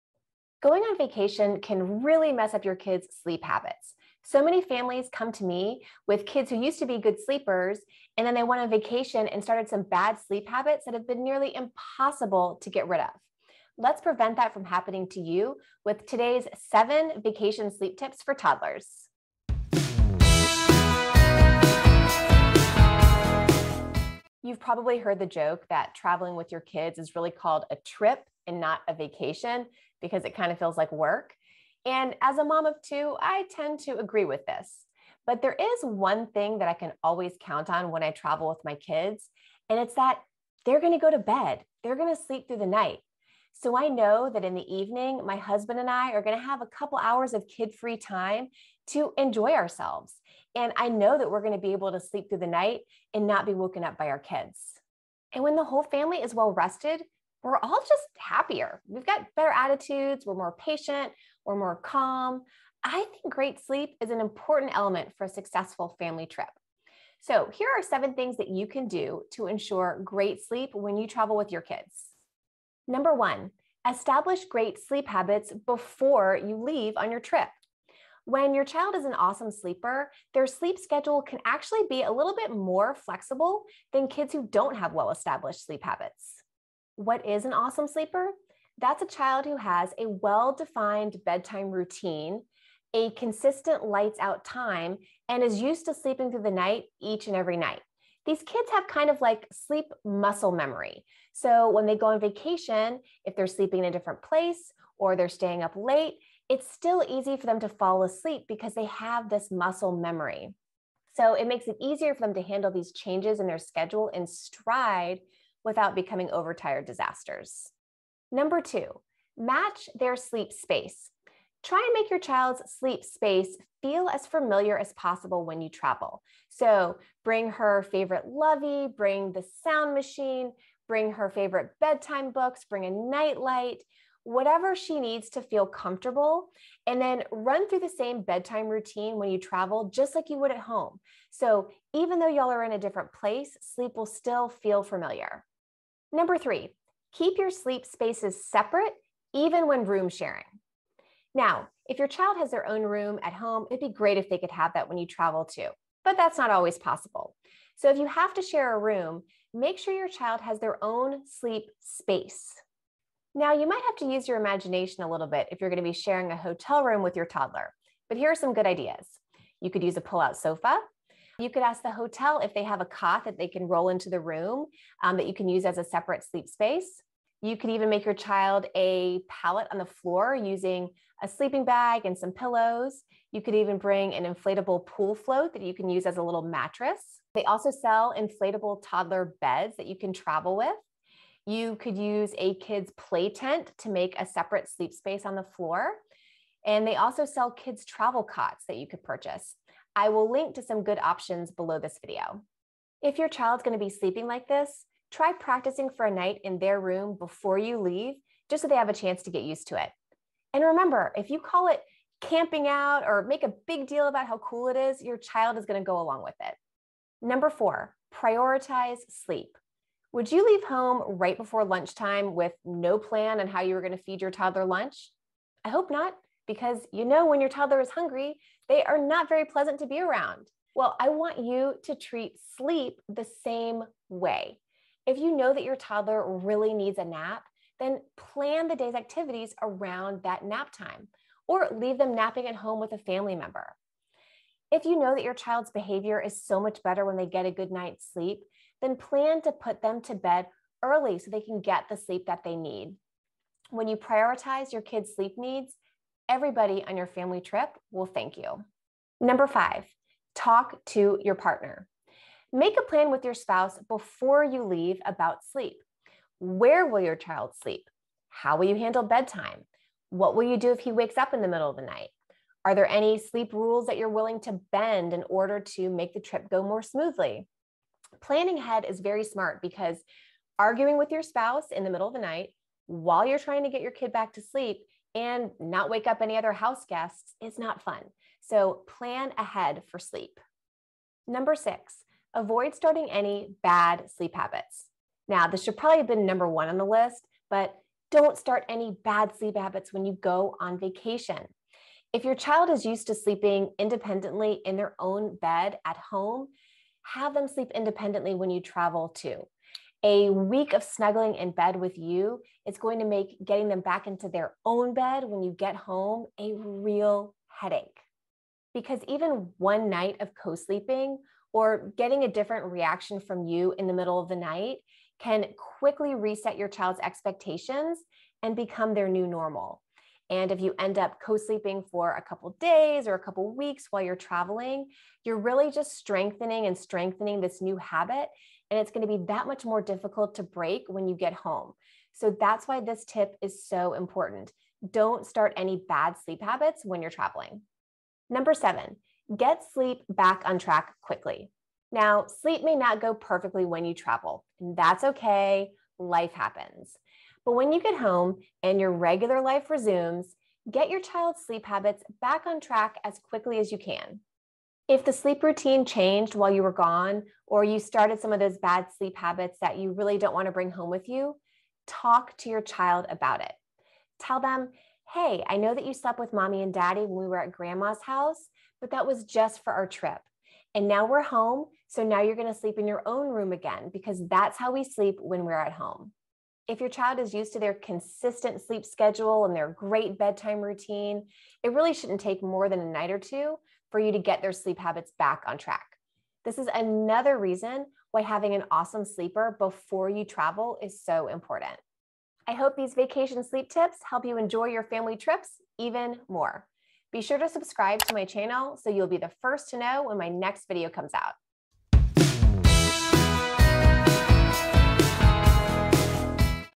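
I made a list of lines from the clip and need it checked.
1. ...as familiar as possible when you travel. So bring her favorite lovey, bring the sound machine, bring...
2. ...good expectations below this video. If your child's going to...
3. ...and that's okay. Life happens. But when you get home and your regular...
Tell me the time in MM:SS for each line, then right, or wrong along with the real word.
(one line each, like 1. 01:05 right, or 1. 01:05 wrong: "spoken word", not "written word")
1. 02:04 right
2. 03:20 wrong: "options", not "expectations"
3. 05:54 right.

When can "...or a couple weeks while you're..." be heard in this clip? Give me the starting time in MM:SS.
05:33.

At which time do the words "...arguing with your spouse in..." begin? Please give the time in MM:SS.
04:40.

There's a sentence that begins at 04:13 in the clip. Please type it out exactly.
When you prioritize your kids' sleep needs, everybody on your family trip will thank you.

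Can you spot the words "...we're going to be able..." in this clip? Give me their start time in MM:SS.
00:51.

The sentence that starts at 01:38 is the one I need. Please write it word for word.
These kids have kind of like sleep muscle memory.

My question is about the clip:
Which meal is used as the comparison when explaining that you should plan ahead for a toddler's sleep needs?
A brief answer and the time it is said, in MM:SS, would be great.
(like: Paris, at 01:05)
lunch, at 03:44.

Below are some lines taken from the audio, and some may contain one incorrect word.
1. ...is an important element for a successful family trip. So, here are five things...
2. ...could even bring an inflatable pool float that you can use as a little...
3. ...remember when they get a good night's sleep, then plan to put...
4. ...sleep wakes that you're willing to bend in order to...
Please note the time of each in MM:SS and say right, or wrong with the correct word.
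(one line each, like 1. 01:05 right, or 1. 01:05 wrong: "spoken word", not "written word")
1. 01:04 wrong: "seven", not "five"
2. 03:03 right
3. 04:06 wrong: "better", not "remember"
4. 04:33 wrong: "rules", not "wakes".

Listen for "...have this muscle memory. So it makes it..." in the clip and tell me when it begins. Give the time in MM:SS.
01:48.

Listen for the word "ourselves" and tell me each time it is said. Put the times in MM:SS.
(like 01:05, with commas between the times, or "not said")
00:49.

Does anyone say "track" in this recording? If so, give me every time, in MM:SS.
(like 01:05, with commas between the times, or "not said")
05:50, 06:02, 06:35.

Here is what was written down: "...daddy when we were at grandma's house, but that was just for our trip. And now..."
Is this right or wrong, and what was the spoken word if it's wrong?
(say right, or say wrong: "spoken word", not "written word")
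right.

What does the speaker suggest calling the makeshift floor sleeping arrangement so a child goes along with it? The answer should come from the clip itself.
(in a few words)
camping out.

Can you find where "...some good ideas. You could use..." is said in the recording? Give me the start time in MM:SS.
02:48.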